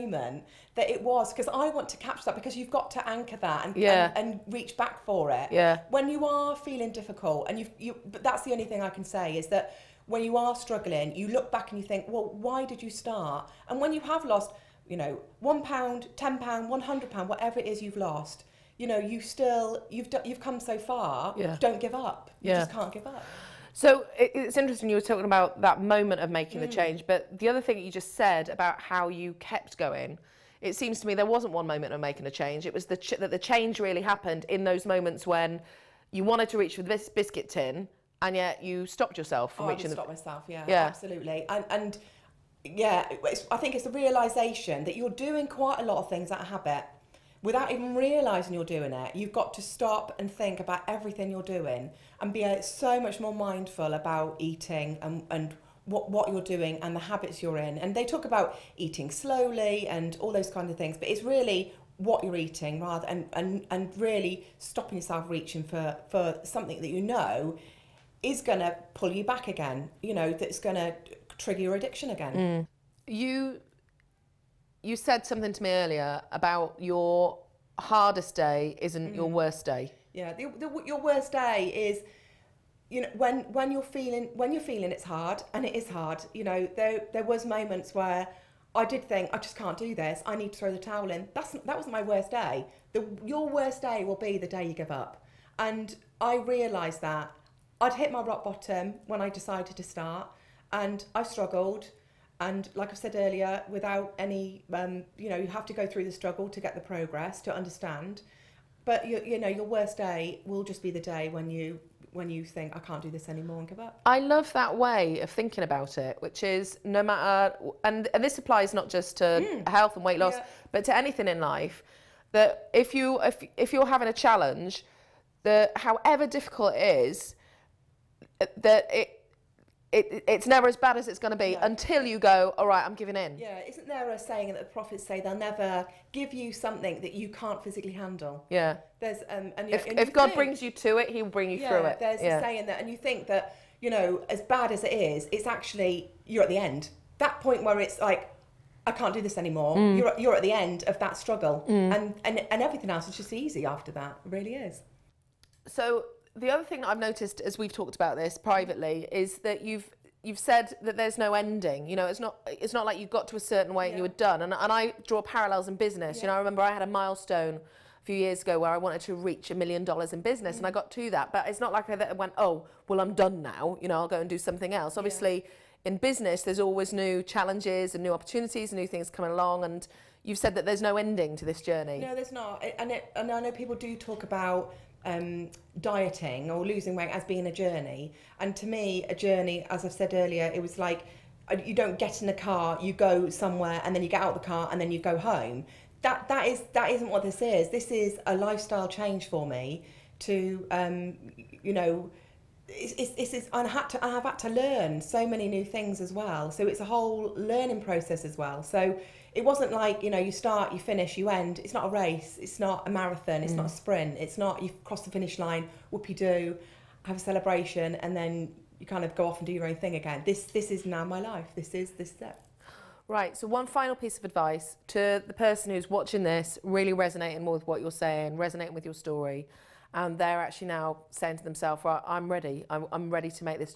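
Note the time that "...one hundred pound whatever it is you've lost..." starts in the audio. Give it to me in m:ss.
0:16.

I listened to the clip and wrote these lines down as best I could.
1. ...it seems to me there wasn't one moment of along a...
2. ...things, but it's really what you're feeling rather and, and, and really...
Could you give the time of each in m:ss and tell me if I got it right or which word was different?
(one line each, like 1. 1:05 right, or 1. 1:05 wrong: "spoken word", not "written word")
1. 0:30 wrong: "making", not "along"
2. 1:00 wrong: "eating", not "feeling".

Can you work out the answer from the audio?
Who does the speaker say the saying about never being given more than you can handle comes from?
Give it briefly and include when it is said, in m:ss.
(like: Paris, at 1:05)
the prophets, at 2:14.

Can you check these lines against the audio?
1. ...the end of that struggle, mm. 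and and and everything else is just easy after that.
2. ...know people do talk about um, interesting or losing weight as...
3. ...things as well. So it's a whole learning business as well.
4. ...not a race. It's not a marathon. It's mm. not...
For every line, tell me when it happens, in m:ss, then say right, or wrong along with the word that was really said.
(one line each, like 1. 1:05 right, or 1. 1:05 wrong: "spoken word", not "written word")
1. 2:30 right
2. 3:03 wrong: "dieting", not "interesting"
3. 3:25 wrong: "process", not "business"
4. 3:31 right.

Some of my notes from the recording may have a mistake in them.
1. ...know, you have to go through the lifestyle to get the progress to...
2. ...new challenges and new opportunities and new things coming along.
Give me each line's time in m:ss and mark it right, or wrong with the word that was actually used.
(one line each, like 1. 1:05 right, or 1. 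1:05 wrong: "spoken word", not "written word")
1. 1:45 wrong: "struggle", not "lifestyle"
2. 2:56 right.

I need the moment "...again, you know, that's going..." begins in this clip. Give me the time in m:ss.
1:09.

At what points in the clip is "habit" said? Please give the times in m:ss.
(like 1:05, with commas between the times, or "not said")
0:46, 0:57.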